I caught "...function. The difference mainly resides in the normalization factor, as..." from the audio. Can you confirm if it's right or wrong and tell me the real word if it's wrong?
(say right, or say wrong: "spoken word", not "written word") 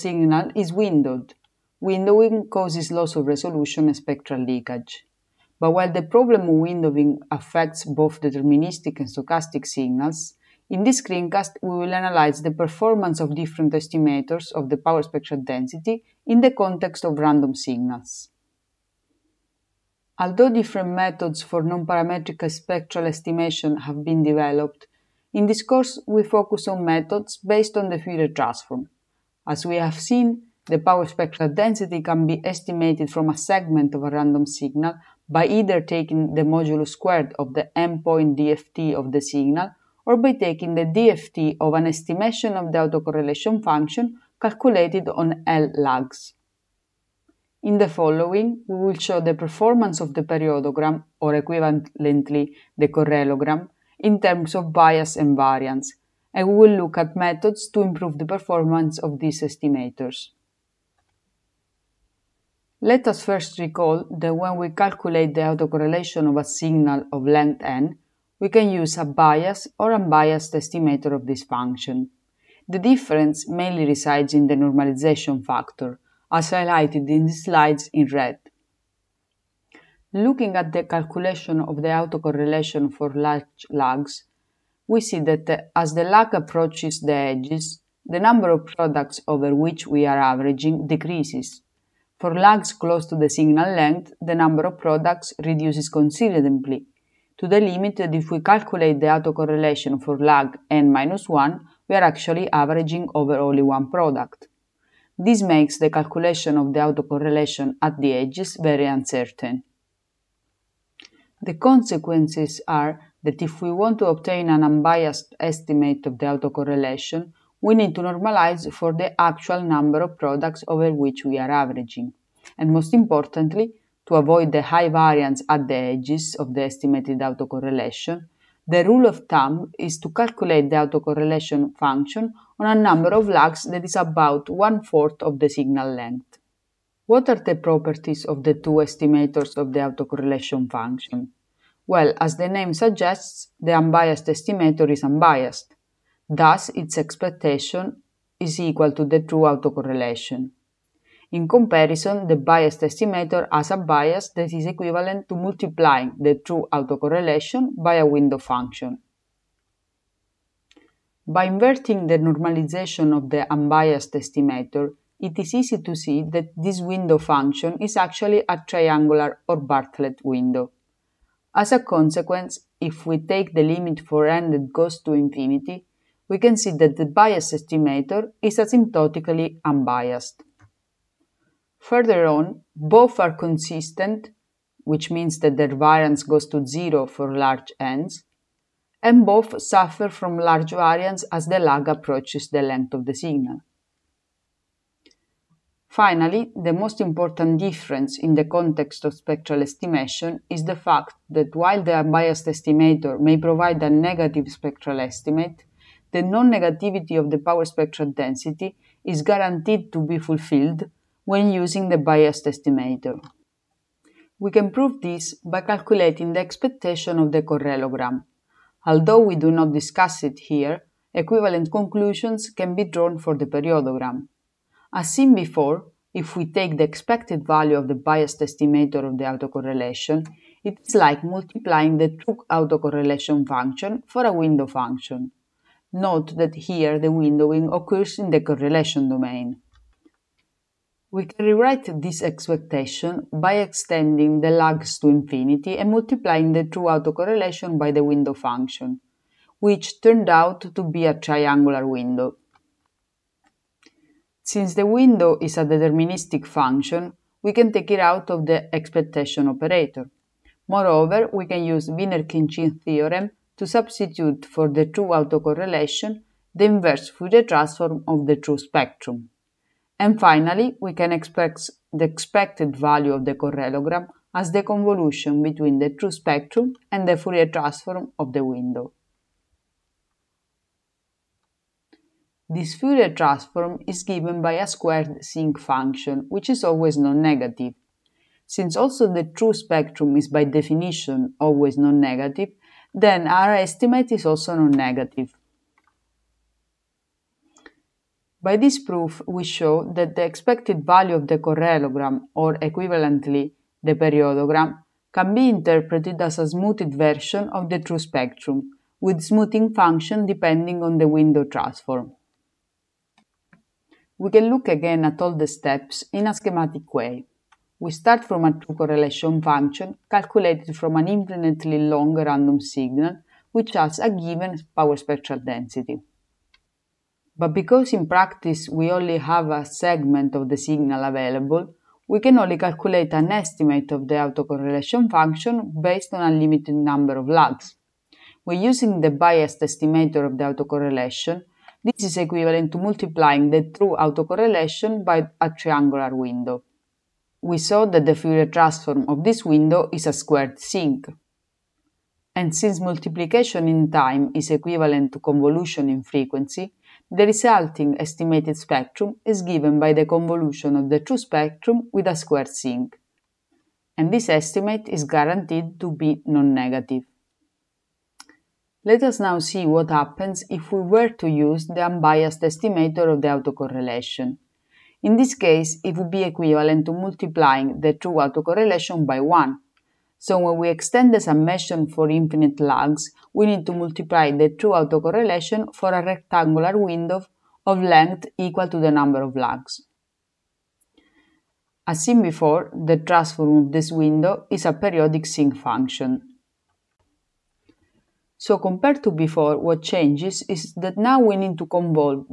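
right.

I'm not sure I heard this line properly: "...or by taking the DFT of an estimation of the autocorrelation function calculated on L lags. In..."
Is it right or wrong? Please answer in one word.
right.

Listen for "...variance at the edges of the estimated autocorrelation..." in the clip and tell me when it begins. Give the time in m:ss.
2:04.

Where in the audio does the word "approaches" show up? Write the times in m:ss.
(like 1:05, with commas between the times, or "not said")
1:26, 3:11.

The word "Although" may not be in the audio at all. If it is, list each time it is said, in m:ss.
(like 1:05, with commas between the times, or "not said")
0:20, 3:38.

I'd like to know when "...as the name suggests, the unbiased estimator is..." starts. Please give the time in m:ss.
2:22.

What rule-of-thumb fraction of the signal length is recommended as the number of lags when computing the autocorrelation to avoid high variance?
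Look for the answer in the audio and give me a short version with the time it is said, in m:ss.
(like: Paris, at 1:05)
one fourth, at 2:14.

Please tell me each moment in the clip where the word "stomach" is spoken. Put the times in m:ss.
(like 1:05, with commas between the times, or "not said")
not said.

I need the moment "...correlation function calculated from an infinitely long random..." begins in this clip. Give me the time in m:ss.
5:18.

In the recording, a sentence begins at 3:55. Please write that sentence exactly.
Note that here the windowing occurs in the correlation domain.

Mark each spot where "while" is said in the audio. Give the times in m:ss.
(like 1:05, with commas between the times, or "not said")
0:05, 3:21.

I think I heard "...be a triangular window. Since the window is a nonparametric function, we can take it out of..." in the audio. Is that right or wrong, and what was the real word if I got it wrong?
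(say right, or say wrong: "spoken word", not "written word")
wrong: "deterministic", not "nonparametric".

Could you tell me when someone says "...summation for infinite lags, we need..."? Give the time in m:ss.
6:21.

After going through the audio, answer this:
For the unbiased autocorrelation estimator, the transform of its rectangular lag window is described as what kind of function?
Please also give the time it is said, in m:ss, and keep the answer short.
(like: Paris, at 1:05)
periodic sinc, at 6:34.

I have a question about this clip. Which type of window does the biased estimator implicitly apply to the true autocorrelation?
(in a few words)
triangular or Bartlett.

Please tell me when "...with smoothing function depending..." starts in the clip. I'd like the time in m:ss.
5:08.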